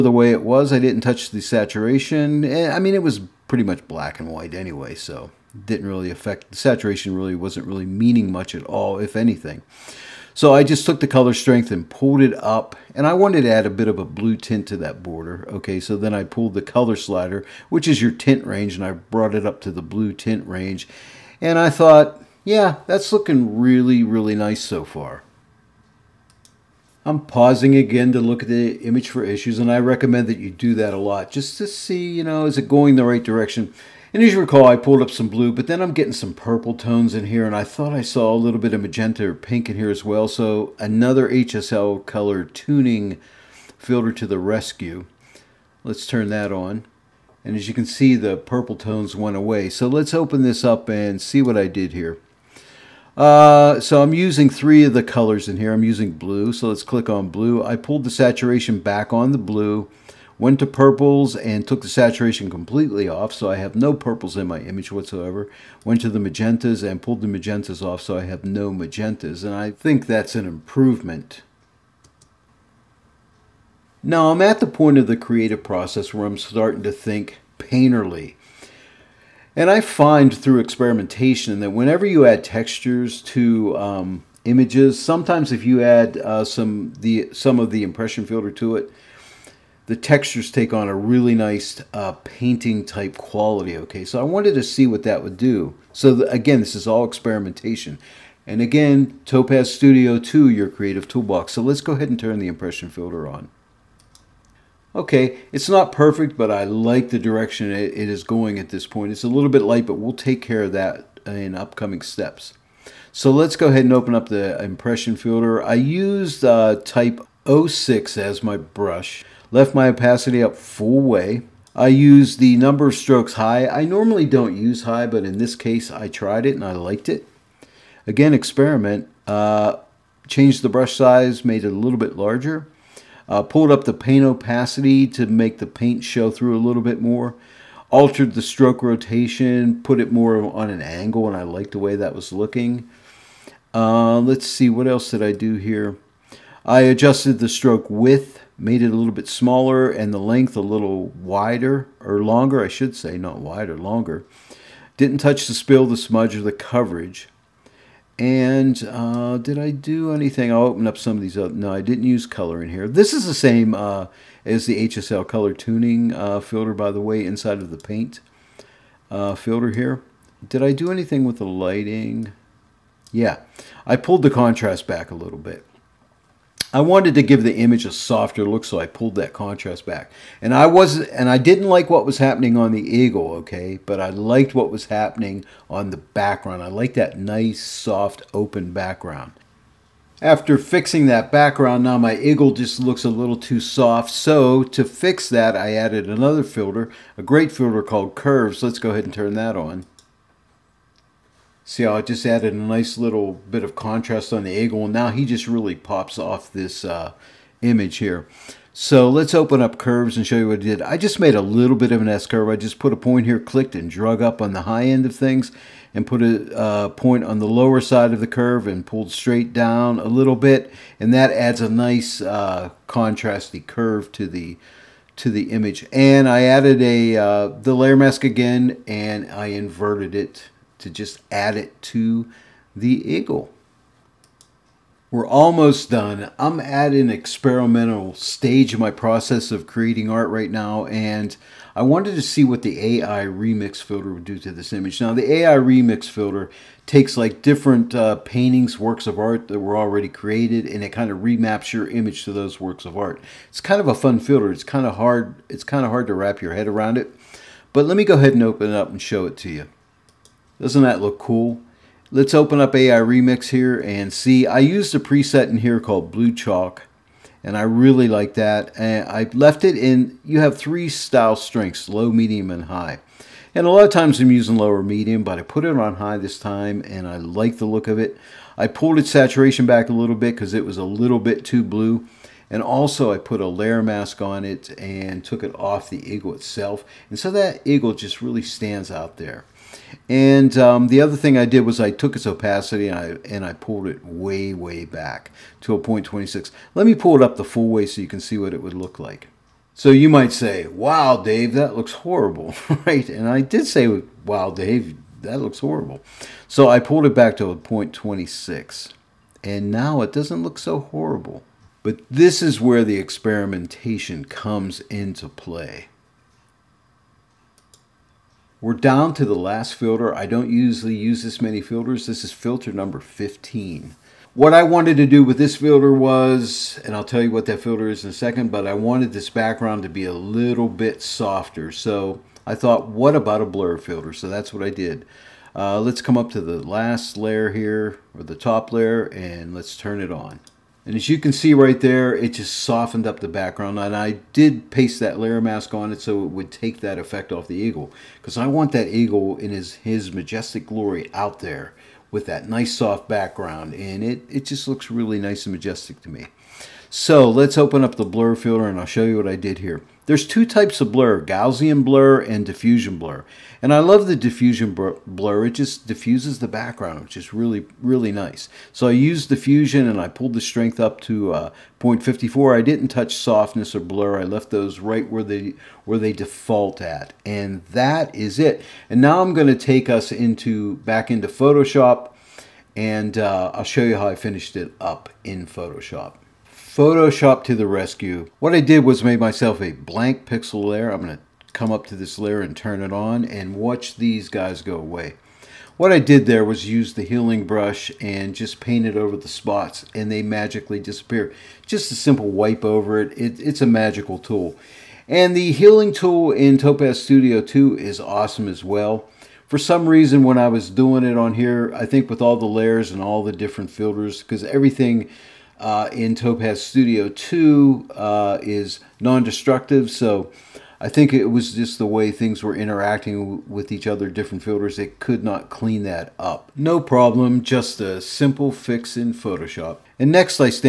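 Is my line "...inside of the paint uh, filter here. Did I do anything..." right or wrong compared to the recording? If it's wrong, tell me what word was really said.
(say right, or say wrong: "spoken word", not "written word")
right.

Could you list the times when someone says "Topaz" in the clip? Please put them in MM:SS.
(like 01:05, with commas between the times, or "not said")
01:39, 06:46, 06:56.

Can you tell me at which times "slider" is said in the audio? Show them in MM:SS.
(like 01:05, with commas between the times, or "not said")
00:16.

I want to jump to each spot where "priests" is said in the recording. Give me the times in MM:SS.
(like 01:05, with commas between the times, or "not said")
not said.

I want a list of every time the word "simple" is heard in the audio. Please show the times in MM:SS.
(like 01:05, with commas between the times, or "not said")
06:41, 07:08.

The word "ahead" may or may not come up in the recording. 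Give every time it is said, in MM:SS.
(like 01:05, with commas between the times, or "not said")
01:41, 01:53, 03:18, 04:18.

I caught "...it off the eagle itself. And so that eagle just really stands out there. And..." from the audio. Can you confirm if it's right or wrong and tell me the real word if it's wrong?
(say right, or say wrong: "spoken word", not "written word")
right.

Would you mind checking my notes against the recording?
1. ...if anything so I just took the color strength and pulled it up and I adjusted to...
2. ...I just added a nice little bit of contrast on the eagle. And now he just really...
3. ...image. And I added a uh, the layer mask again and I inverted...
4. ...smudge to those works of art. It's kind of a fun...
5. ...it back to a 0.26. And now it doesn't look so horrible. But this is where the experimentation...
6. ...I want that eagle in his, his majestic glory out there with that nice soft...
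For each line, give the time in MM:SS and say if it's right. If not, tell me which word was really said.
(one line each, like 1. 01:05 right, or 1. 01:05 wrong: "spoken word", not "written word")
1. 00:08 wrong: "wanted", not "adjusted"
2. 03:21 right
3. 03:45 right
4. 04:11 wrong: "image", not "smudge"
5. 05:07 right
6. 05:48 right.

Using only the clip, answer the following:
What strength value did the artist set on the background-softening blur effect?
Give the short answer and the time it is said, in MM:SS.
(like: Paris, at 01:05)
0.54, at 06:11.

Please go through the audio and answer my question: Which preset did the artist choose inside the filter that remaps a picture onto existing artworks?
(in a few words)
Blue Chalk.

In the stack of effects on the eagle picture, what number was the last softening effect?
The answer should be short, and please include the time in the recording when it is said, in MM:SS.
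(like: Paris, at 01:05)
15, at 05:22.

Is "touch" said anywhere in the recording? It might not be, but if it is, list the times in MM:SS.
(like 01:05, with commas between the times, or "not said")
00:01, 02:35, 06:12.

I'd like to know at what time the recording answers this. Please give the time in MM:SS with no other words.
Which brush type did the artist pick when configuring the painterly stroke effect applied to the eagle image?
01:56.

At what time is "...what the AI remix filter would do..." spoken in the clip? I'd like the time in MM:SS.
04:02.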